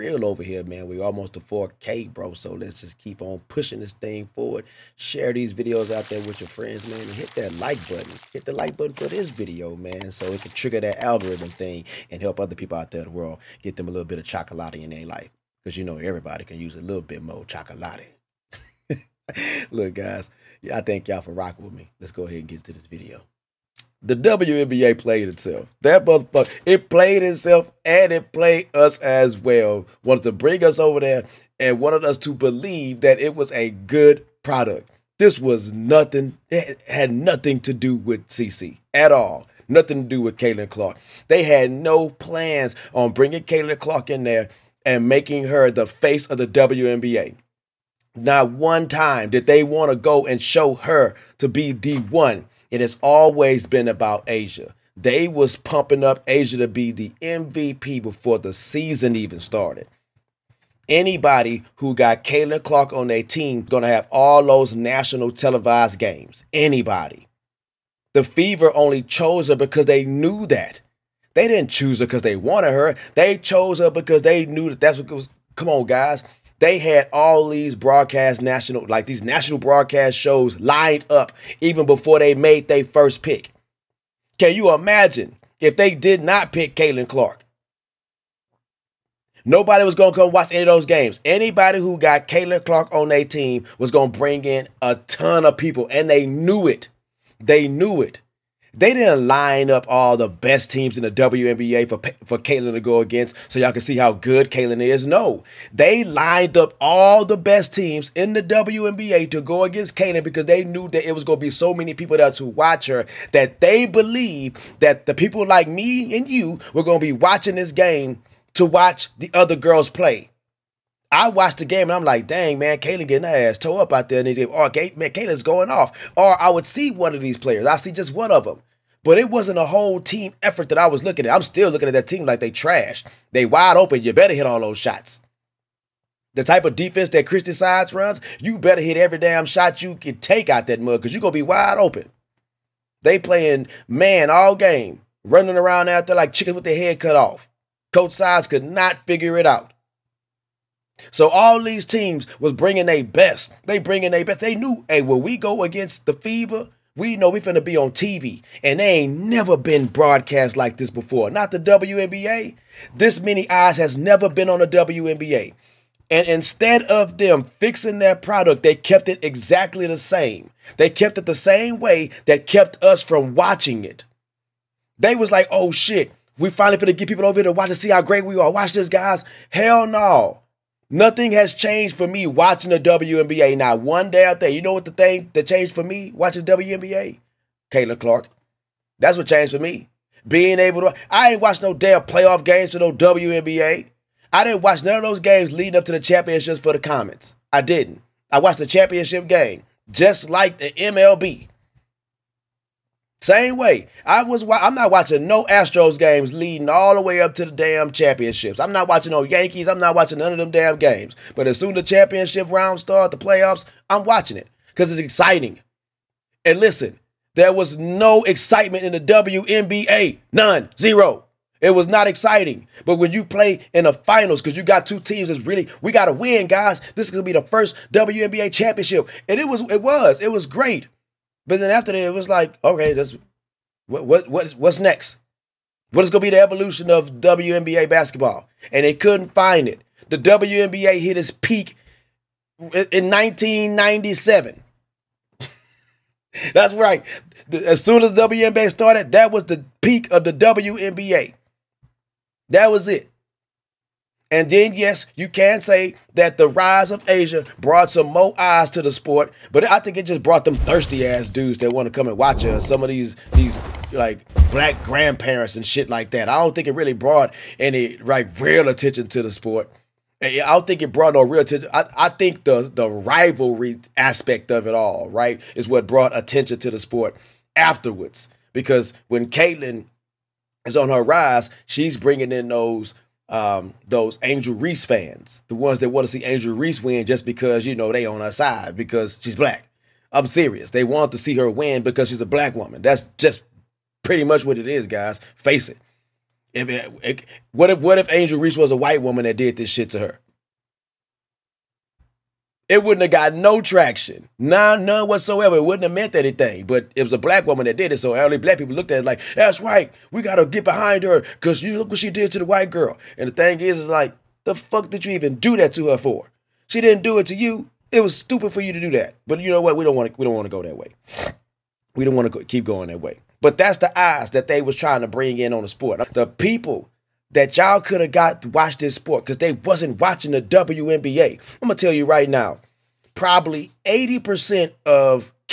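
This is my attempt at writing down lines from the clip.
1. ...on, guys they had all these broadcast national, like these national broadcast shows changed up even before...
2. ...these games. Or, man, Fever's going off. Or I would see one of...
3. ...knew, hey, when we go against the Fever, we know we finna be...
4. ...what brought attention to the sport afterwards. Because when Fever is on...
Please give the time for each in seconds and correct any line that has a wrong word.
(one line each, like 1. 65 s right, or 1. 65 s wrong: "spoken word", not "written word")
1. 75 s wrong: "lined", not "changed"
2. 124 s wrong: "Caitlin", not "Fever"
3. 154 s right
4. 275 s wrong: "Caitlin", not "Fever".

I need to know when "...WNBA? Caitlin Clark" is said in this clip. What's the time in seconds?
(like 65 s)
186 s.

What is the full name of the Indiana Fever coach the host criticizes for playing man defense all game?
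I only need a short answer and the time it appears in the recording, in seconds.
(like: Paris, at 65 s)
Christie Sides, at 137 s.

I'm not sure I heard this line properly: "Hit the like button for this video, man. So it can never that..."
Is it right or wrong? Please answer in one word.
wrong.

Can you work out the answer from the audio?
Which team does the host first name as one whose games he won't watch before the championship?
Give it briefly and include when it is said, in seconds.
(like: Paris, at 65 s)
Astros, at 205 s.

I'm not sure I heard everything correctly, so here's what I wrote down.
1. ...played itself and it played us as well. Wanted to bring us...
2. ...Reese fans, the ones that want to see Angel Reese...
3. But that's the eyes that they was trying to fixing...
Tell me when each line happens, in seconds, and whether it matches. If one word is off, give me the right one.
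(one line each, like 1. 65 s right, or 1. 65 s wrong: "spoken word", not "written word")
1. 26 s right
2. 284 s right
3. 323 s wrong: "bring", not "fixing".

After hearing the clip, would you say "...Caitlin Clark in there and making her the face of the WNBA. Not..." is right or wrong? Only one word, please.
right.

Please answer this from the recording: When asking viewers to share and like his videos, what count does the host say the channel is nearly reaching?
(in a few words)
4K.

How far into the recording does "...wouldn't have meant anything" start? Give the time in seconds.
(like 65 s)
305 s.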